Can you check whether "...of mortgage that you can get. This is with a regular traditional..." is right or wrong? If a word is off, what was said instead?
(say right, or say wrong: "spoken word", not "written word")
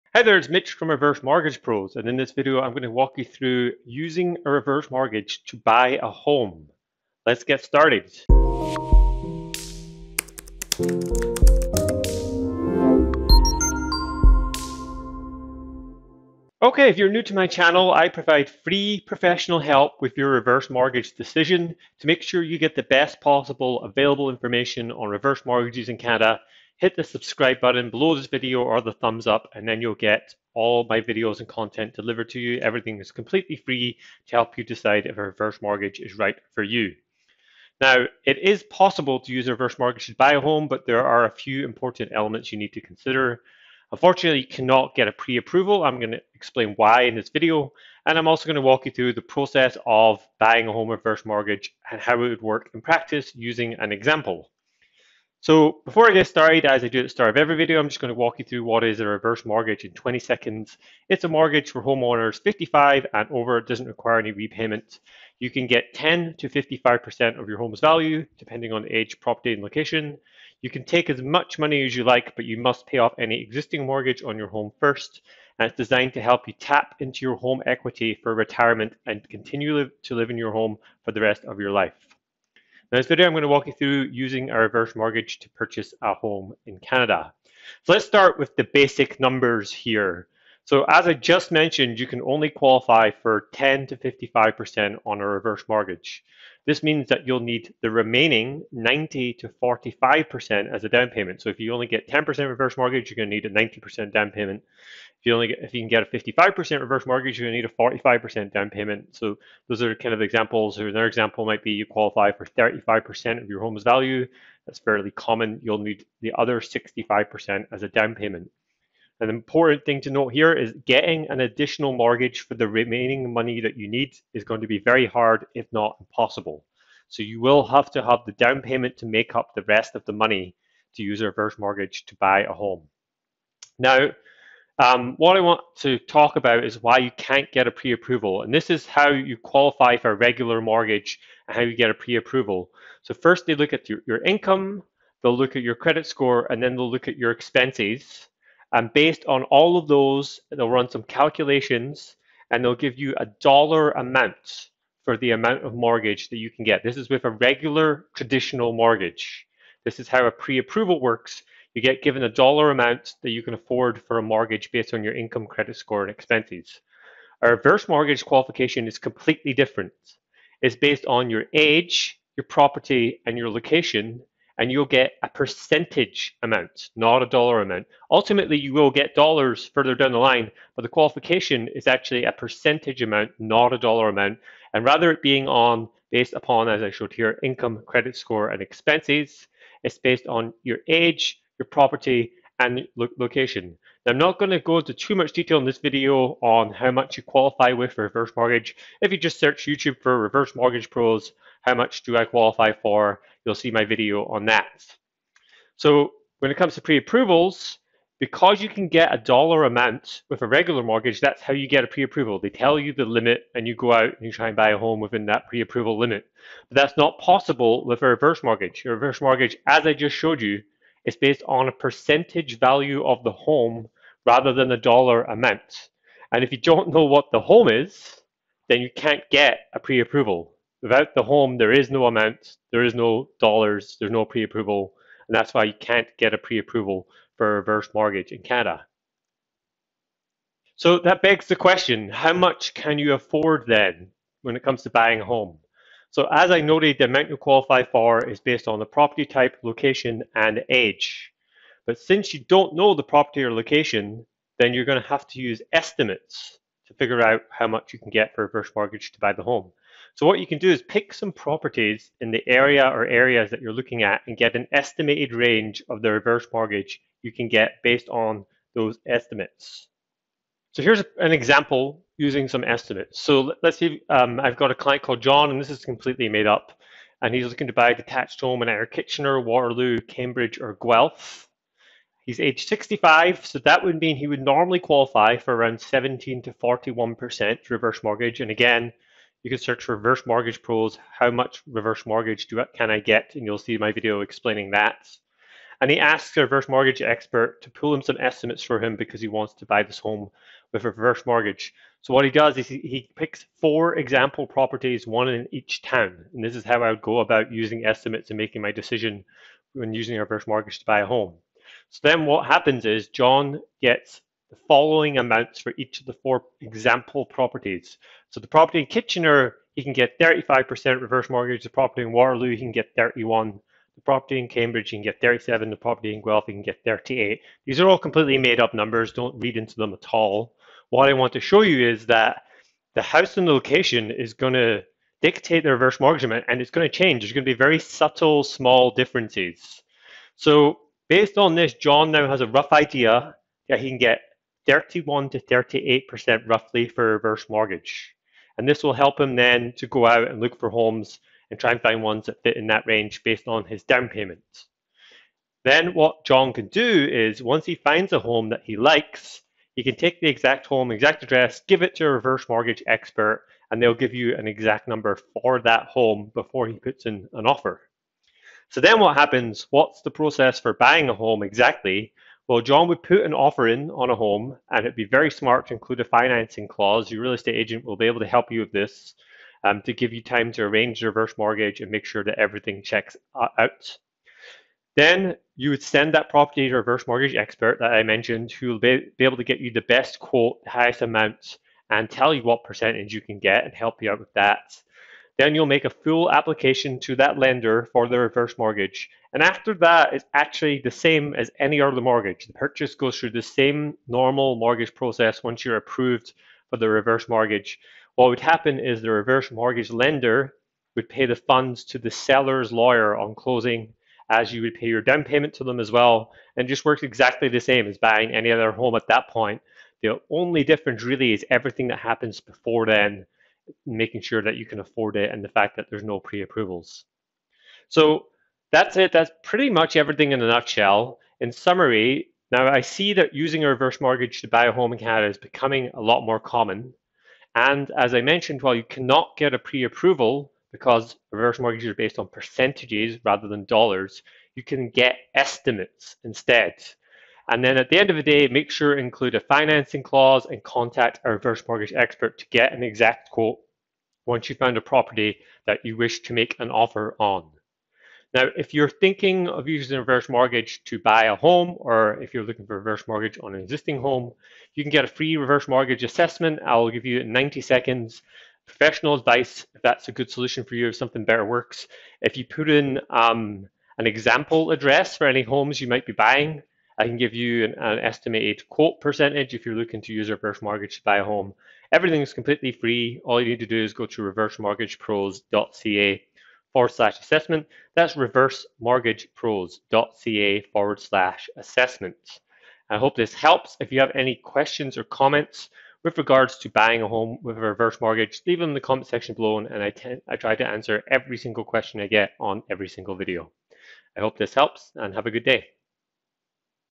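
right.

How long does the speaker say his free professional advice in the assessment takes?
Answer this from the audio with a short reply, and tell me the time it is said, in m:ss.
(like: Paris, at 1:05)
90 seconds, at 7:47.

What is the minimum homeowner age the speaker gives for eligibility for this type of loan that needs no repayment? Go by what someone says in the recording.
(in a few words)
55.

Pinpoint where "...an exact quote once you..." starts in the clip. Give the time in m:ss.
7:32.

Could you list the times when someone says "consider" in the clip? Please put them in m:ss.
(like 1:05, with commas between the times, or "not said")
0:42.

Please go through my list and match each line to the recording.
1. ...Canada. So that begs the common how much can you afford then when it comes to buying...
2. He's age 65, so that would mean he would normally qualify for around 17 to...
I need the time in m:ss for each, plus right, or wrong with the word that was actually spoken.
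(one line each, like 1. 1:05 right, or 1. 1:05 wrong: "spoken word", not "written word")
1. 3:58 wrong: "question", not "common"
2. 4:42 right.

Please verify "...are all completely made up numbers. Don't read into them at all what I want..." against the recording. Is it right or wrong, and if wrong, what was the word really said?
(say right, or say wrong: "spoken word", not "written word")
right.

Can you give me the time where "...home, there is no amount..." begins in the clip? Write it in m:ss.
3:51.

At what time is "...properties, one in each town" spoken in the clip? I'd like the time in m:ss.
5:04.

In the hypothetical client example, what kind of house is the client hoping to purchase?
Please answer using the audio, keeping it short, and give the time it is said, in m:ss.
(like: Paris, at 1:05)
detached home, at 4:37.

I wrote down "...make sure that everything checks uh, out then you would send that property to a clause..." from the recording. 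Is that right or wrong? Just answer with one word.
wrong.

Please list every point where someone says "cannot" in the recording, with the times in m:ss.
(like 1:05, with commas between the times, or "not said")
0:44, 7:18.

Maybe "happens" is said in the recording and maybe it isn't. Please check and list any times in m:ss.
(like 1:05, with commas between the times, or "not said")
5:12, 6:09, 6:48, 7:01.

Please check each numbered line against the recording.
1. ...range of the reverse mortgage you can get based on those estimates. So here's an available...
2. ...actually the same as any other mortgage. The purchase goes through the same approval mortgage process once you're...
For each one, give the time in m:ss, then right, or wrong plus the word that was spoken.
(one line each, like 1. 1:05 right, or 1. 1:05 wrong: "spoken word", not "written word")
1. 4:25 wrong: "example", not "available"
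2. 6:40 wrong: "normal", not "approval".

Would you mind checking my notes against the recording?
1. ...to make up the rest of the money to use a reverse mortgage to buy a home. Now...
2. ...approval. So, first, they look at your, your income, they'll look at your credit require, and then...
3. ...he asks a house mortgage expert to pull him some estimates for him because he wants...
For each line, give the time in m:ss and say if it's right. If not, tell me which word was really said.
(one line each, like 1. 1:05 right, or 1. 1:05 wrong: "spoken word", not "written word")
1. 2:08 right
2. 2:22 wrong: "score", not "require"
3. 4:55 wrong: "reverse", not "house".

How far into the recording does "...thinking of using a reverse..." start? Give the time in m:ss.
7:38.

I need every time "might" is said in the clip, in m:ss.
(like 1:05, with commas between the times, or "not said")
1:51, 7:55.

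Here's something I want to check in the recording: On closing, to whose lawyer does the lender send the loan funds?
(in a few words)
the seller's lawyer.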